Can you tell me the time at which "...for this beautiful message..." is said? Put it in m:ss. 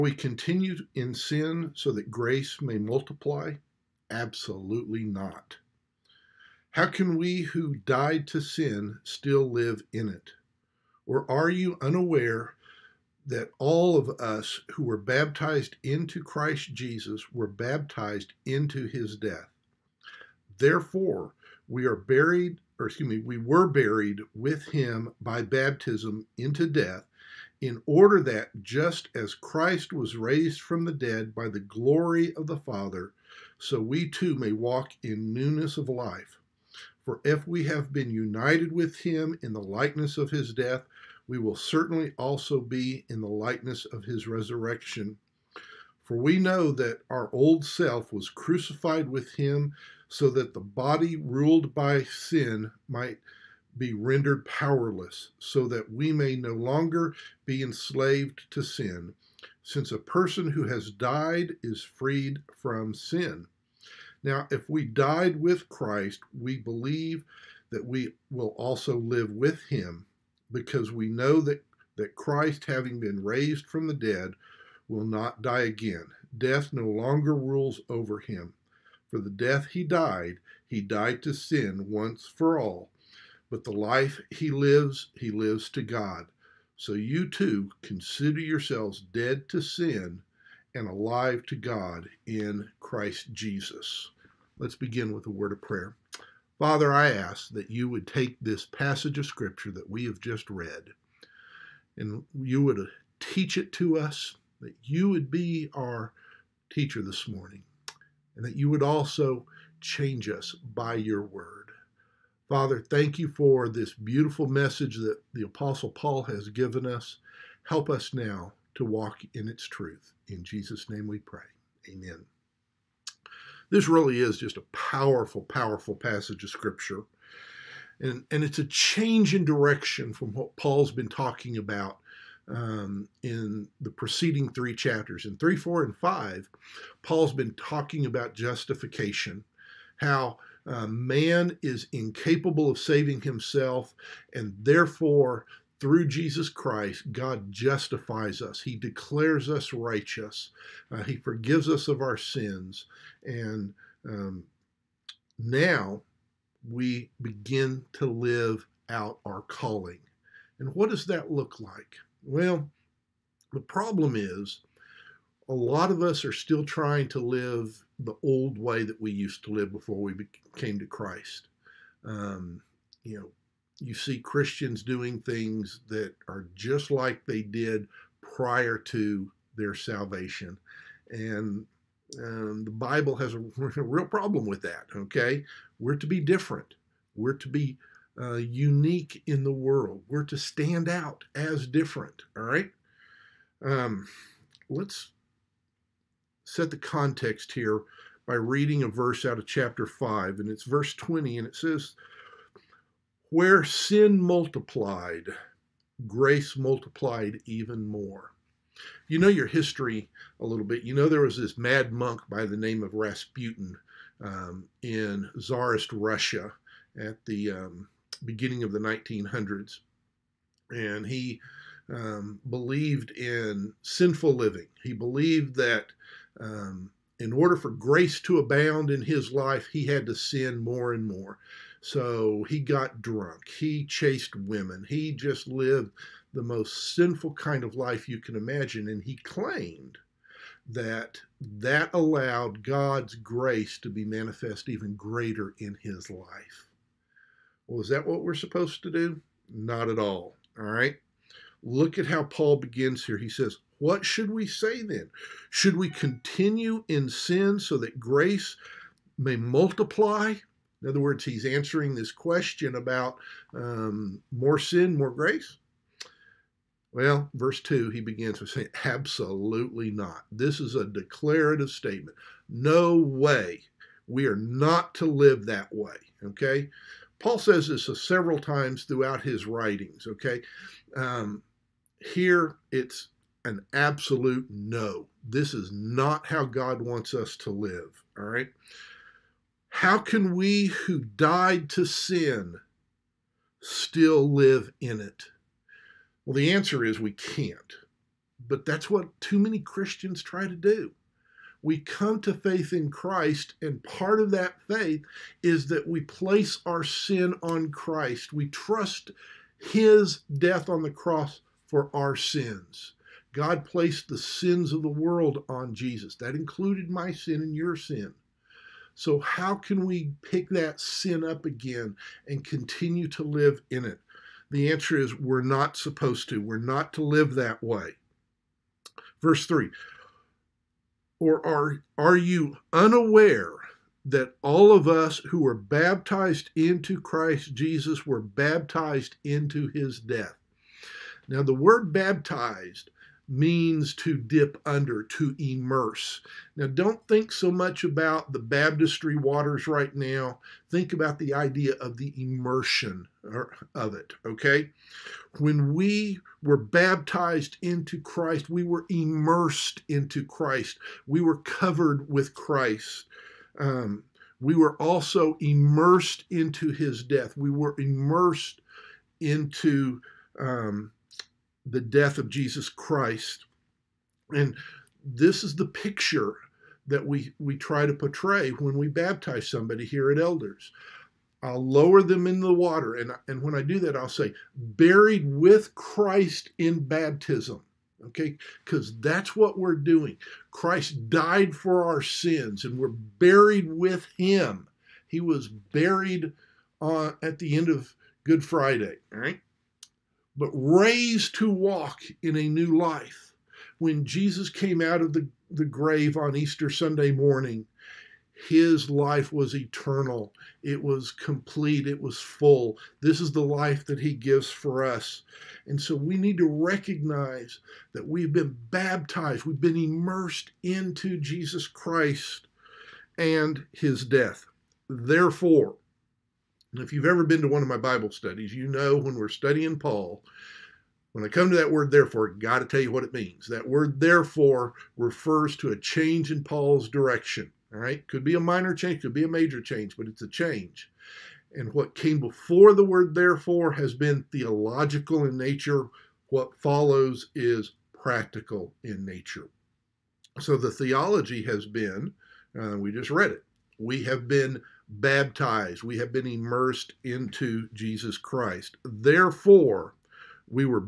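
1:53.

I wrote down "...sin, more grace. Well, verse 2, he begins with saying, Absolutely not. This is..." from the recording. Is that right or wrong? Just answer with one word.
right.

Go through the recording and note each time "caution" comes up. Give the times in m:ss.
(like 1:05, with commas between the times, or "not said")
not said.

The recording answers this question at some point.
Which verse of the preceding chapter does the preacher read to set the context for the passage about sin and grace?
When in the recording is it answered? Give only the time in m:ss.
3:20.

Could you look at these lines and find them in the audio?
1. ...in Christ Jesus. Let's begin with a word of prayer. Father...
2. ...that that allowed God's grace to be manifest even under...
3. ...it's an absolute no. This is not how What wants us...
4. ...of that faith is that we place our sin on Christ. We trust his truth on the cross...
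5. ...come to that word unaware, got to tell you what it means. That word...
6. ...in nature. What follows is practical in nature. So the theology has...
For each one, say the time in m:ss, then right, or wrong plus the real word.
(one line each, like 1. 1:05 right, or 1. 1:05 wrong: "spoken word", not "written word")
1. 1:32 right
2. 4:00 wrong: "greater", not "under"
3. 4:42 wrong: "God", not "What"
4. 5:04 wrong: "death", not "truth"
5. 7:11 wrong: "therefore", not "unaware"
6. 7:25 right.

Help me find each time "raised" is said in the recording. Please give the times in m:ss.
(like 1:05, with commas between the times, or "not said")
0:30, 1:13, 6:40.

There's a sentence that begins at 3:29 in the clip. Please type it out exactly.
You know your history a little bit.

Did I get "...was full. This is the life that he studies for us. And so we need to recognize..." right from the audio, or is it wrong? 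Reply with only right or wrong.
wrong.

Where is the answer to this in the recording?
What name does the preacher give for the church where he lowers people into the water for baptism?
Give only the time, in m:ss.
6:20.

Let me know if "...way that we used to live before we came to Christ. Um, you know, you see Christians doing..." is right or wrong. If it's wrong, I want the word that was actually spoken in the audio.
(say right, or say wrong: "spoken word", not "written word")
right.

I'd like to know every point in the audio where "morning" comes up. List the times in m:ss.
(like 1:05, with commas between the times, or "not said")
1:47, 6:47.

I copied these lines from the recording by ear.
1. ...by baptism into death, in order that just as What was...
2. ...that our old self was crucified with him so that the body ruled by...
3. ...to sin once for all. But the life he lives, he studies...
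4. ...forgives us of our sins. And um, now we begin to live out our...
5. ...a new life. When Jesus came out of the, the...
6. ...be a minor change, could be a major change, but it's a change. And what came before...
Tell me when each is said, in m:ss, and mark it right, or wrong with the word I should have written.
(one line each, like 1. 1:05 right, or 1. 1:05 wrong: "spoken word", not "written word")
1. 0:25 wrong: "Christ", not "What"
2. 0:46 right
3. 1:21 wrong: "lives", not "studies"
4. 2:31 right
5. 6:42 right
6. 7:18 right.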